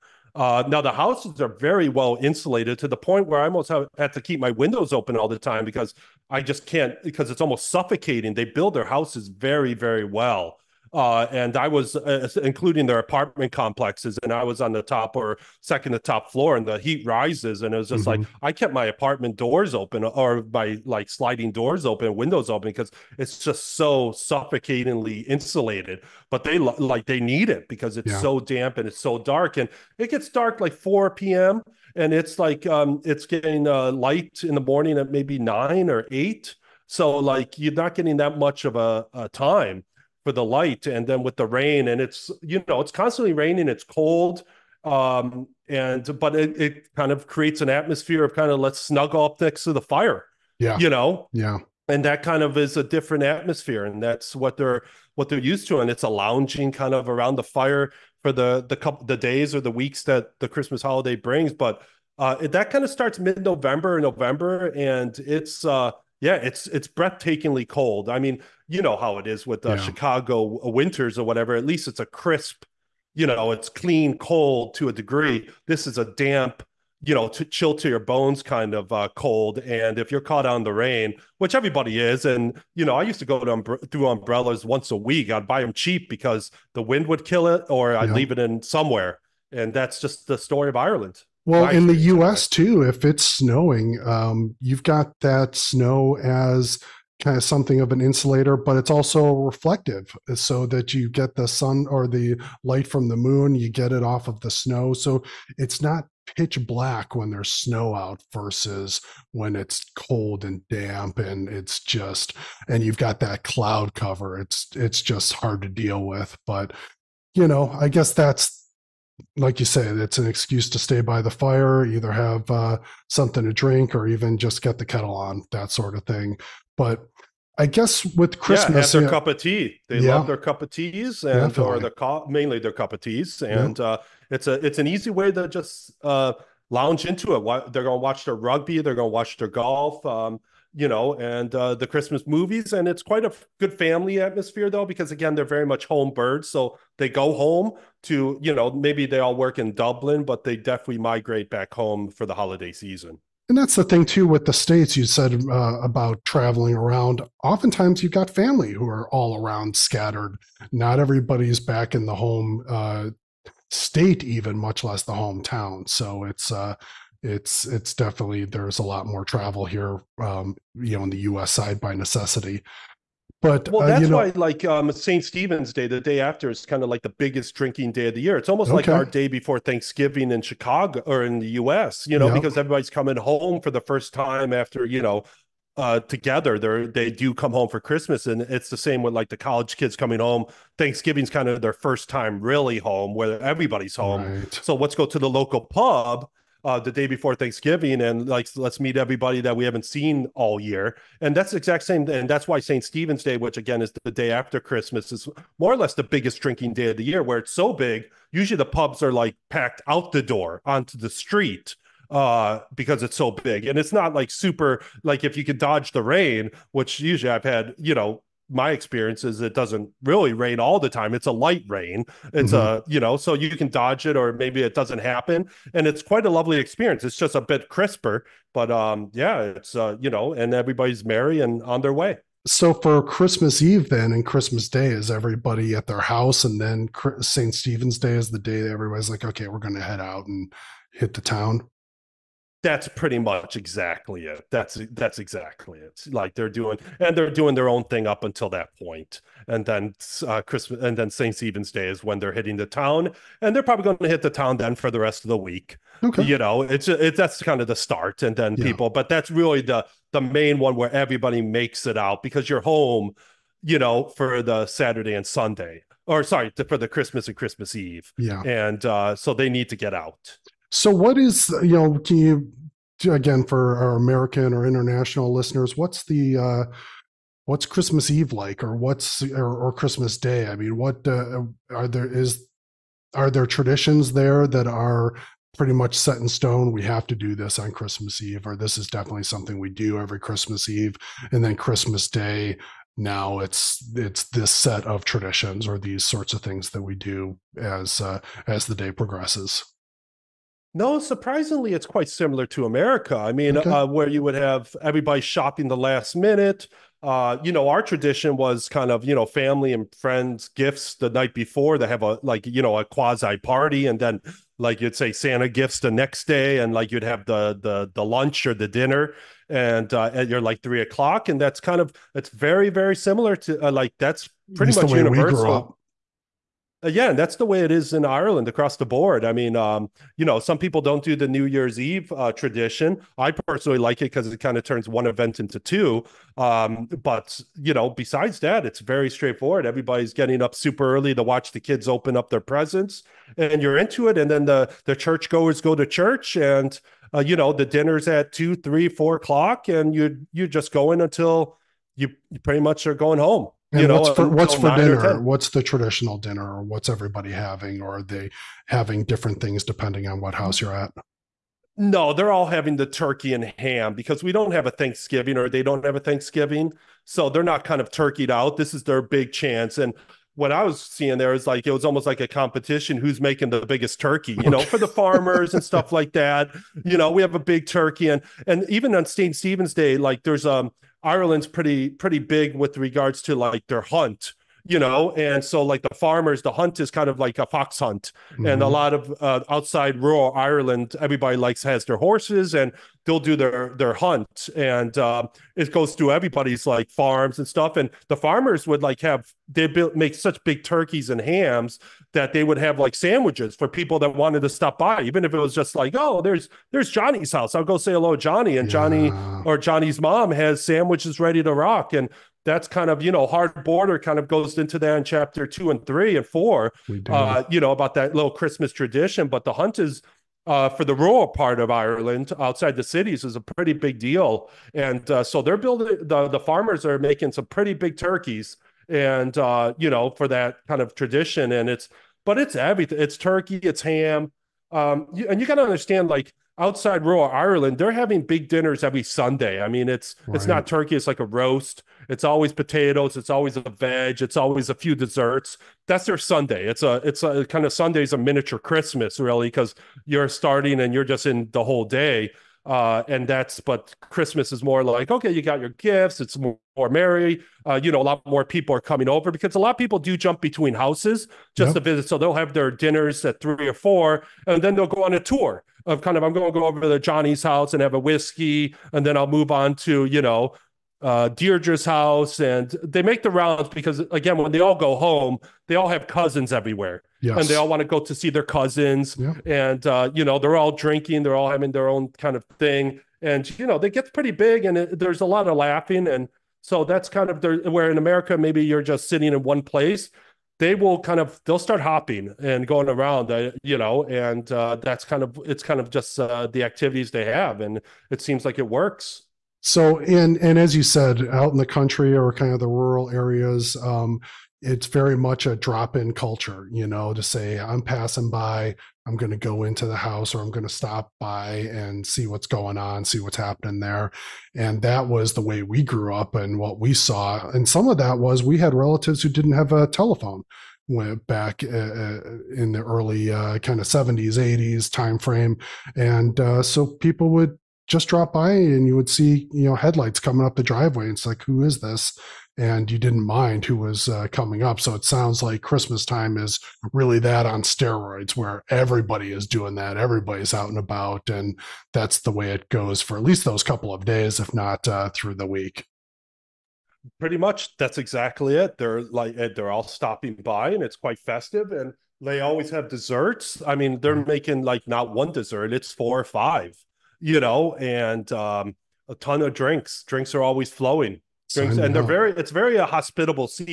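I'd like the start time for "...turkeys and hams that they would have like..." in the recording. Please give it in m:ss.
6:40.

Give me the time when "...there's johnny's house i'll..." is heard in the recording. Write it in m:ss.
6:46.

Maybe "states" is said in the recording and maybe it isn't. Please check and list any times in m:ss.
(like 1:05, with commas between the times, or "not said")
2:34, 2:43.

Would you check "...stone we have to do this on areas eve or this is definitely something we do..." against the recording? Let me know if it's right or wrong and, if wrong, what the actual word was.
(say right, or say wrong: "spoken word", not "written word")
wrong: "christmas", not "areas".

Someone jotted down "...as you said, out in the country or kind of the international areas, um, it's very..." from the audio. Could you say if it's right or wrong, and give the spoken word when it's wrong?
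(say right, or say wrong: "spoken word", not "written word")
wrong: "rural", not "international".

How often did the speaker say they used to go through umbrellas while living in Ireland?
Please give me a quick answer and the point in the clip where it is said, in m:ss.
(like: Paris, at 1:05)
Once a week, at 1:24.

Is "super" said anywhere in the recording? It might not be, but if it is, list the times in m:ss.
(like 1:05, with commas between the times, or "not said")
3:34, 5:40.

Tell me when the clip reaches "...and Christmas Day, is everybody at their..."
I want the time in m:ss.
3:54.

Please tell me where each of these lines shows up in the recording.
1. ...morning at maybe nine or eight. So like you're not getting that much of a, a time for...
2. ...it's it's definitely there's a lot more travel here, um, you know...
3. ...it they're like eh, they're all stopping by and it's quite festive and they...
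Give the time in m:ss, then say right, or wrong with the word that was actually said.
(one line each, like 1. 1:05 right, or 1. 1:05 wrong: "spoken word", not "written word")
1. 0:34 right
2. 2:47 right
3. 9:08 right.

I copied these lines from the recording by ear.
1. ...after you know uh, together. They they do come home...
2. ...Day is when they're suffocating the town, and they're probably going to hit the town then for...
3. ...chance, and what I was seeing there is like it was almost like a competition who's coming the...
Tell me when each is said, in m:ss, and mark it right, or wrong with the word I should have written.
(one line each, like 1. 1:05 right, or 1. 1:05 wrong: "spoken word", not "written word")
1. 3:04 right
2. 4:11 wrong: "hitting", not "suffocating"
3. 6:09 wrong: "making", not "coming".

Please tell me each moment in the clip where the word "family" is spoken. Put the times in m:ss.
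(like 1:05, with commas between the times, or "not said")
2:23, 2:38, 5:09.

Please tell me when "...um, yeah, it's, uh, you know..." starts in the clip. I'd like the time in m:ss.
3:48.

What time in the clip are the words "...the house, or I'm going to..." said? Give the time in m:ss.
8:29.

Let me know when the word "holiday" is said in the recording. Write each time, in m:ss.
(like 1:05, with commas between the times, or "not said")
1:00, 2:32.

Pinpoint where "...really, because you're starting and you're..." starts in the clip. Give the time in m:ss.
7:29.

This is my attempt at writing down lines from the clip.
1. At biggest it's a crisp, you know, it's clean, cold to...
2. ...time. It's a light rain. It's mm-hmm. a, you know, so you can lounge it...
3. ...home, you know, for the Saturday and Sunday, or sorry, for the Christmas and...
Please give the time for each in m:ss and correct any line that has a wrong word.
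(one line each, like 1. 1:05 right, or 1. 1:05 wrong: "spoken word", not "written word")
1. 1:11 wrong: "least", not "biggest"
2. 3:40 wrong: "dodge", not "lounge"
3. 4:22 right.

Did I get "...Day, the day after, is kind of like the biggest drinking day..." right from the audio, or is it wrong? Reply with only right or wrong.
right.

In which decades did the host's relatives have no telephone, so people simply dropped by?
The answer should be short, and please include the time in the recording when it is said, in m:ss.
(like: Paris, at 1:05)
70s and 80s, at 8:43.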